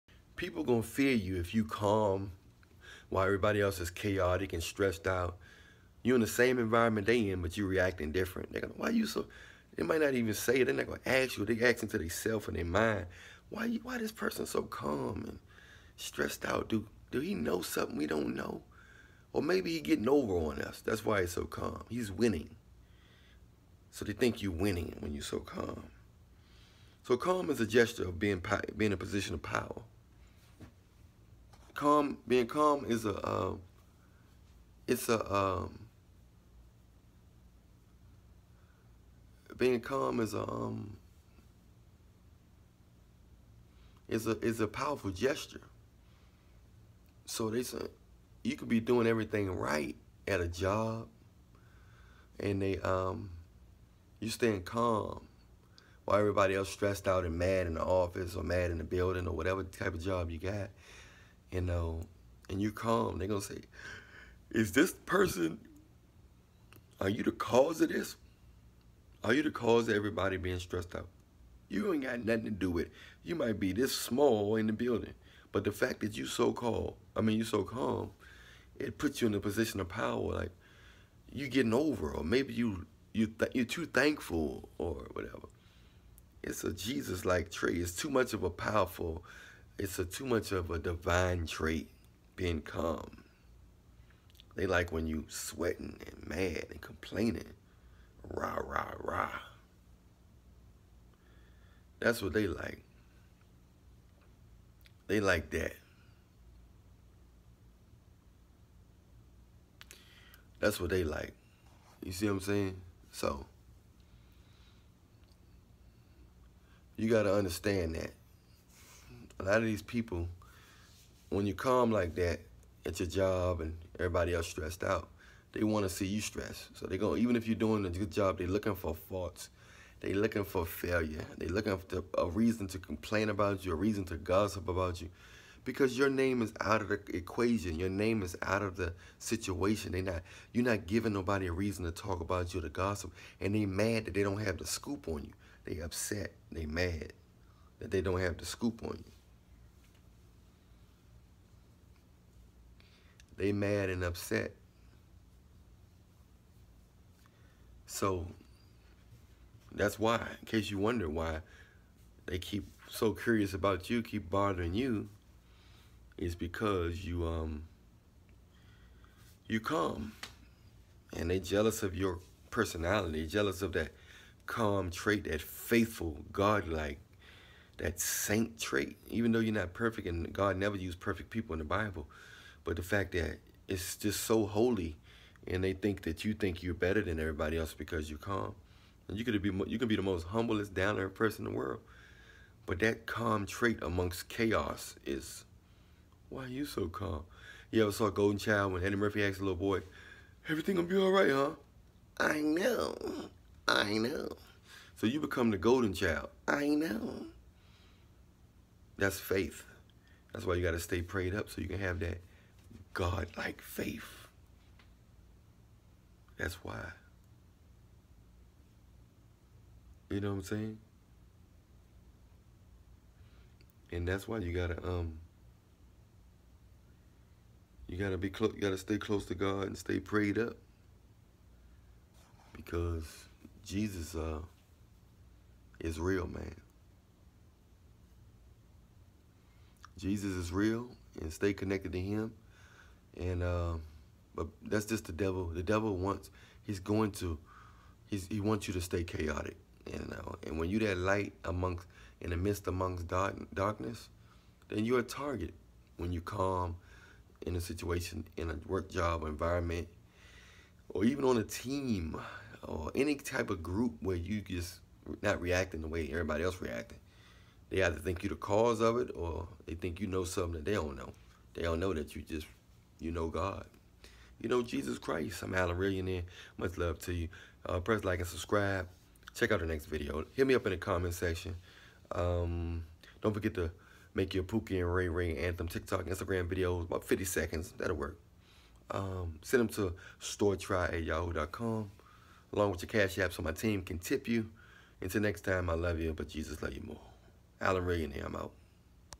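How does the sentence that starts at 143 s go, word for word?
And they mad that they don't have the scoop on you.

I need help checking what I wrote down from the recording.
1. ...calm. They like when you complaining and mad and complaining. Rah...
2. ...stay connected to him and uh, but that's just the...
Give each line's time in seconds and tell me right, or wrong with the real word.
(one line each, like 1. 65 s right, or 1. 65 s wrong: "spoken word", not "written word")
1. 92 s wrong: "sweating", not "complaining"
2. 241 s right.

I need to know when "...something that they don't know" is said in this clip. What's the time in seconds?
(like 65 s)
270 s.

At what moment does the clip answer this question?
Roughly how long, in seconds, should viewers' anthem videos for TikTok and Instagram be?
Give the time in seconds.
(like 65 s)
287 s.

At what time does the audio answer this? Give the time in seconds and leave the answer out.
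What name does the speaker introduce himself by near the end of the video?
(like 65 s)
275 s.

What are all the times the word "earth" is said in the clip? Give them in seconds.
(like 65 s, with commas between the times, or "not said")
190 s.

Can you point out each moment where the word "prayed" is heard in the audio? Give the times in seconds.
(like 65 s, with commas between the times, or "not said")
211 s, 229 s.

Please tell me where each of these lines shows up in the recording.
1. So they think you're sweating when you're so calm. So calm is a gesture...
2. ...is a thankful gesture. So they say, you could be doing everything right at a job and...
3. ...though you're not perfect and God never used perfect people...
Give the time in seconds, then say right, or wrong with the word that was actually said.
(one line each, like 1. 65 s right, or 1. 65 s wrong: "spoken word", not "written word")
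1. 23 s wrong: "winning", not "sweating"
2. 44 s wrong: "powerful", not "thankful"
3. 179 s right.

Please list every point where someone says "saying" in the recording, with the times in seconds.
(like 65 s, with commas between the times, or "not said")
112 s, 220 s.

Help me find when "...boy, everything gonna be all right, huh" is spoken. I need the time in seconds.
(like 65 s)
199 s.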